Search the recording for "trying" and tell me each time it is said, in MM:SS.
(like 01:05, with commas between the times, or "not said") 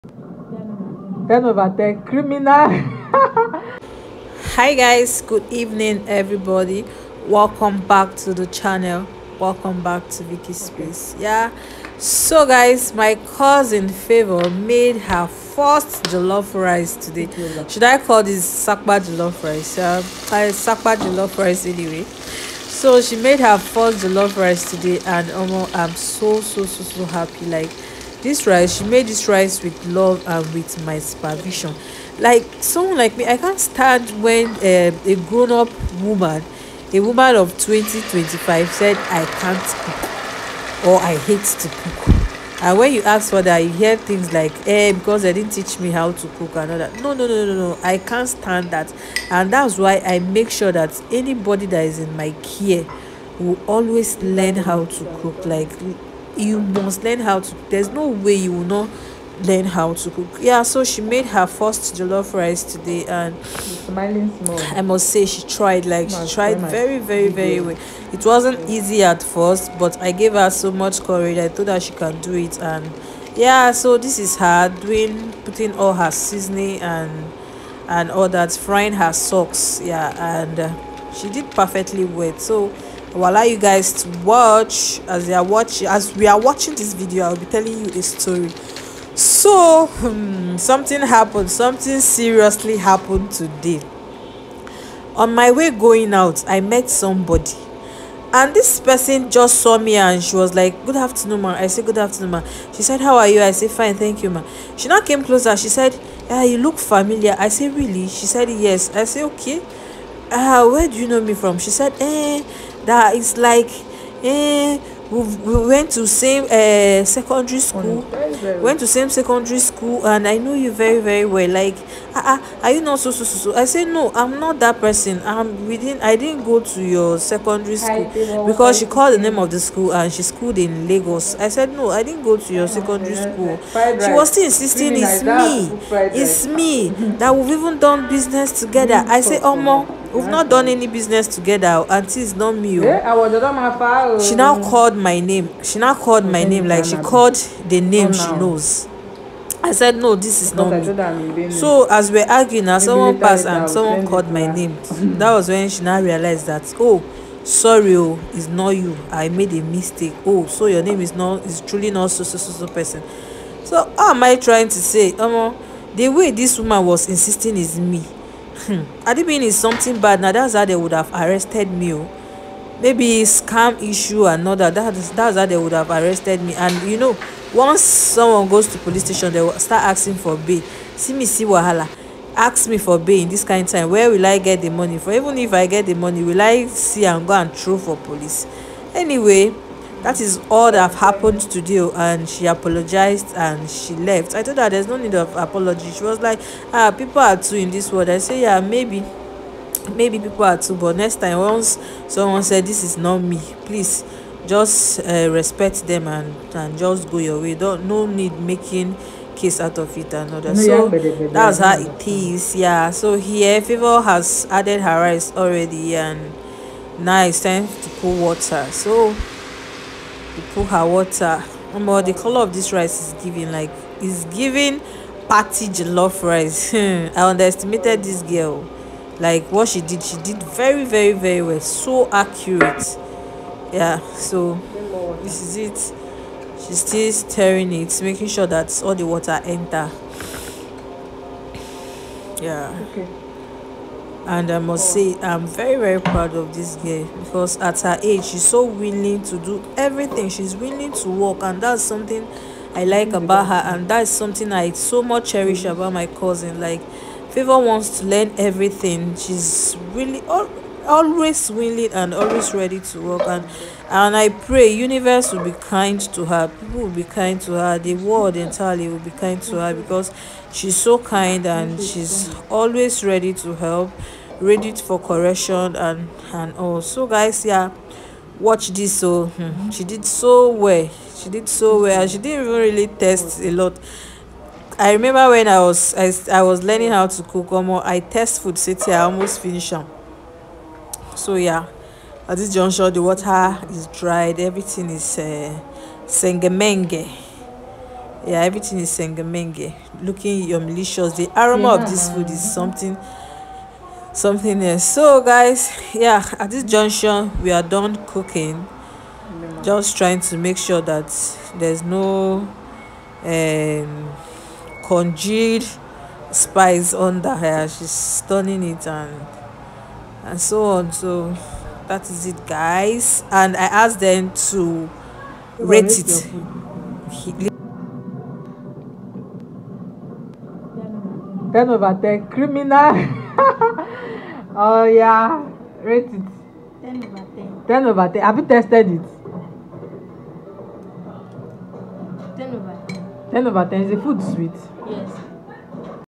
02:44, 05:09.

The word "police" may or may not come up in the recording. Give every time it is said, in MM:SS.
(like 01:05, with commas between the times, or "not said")
02:58, 03:07.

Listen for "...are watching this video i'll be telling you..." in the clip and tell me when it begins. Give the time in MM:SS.
01:26.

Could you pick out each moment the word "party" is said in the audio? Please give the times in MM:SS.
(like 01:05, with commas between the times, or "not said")
03:45.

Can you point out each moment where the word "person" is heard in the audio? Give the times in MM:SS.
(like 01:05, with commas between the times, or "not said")
01:38, 02:04, 02:42.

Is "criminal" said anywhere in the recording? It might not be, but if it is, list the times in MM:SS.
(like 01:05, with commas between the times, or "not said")
00:02, 05:32.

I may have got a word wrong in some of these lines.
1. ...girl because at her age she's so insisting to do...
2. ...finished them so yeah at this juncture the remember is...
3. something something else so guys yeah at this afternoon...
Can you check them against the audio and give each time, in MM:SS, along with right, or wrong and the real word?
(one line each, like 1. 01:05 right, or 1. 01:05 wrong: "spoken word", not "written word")
1. 04:06 wrong: "willing", not "insisting"
2. 04:49 wrong: "water", not "remember"
3. 05:02 wrong: "junction", not "afternoon".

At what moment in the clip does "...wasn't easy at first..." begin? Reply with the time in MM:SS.
01:08.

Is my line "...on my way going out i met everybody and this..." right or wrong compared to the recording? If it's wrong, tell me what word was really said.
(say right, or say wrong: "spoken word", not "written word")
wrong: "somebody", not "everybody".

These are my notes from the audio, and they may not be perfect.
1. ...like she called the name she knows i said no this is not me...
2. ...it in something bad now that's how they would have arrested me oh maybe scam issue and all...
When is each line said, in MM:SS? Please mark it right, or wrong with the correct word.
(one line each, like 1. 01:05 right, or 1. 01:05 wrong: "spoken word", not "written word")
1. 02:26 right
2. 02:49 right.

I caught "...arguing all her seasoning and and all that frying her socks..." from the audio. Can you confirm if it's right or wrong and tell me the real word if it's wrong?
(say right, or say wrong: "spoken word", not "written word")
wrong: "putting", not "arguing".